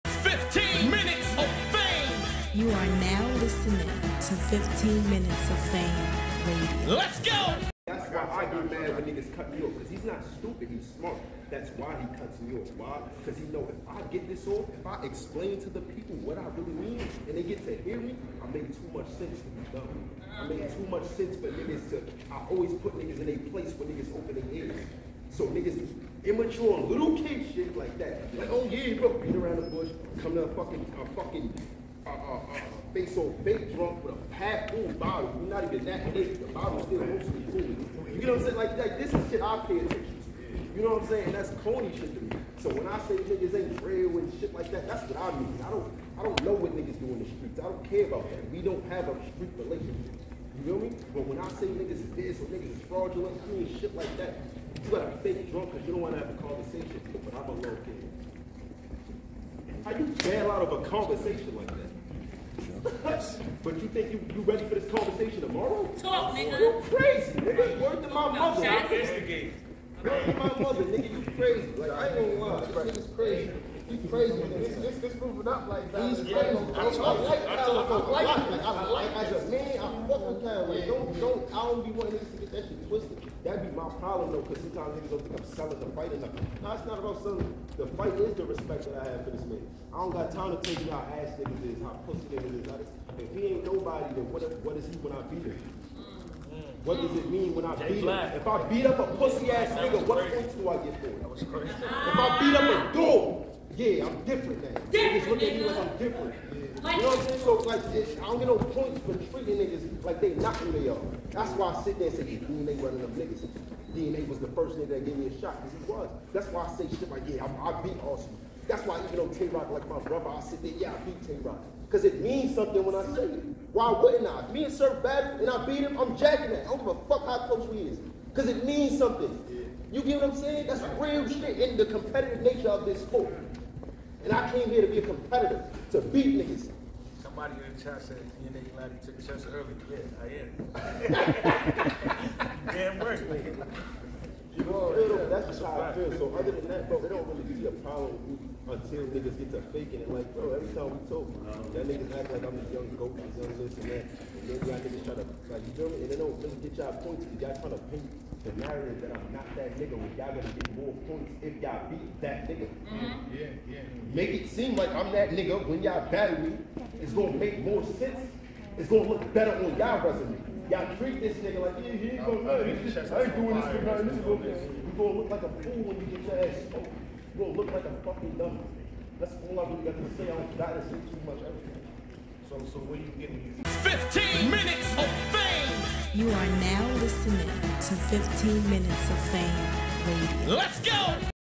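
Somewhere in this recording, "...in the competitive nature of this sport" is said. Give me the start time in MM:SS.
02:11.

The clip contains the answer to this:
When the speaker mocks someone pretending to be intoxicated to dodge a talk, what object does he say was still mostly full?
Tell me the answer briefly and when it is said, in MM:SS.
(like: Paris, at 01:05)
The bottle, at 00:36.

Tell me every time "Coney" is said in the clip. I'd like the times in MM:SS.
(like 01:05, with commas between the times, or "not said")
00:41.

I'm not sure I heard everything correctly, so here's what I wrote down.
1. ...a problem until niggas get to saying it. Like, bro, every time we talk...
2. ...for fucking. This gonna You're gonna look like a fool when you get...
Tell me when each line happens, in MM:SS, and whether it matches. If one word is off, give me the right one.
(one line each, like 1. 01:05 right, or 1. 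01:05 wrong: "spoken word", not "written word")
1. 02:27 wrong: "faking", not "saying"
2. 02:53 wrong: "nothing", not "fucking".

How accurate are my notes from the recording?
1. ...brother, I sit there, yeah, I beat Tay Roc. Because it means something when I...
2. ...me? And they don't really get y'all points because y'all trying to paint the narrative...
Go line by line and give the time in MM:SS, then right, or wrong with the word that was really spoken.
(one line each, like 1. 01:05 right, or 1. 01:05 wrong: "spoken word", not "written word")
1. 01:59 right
2. 02:35 right.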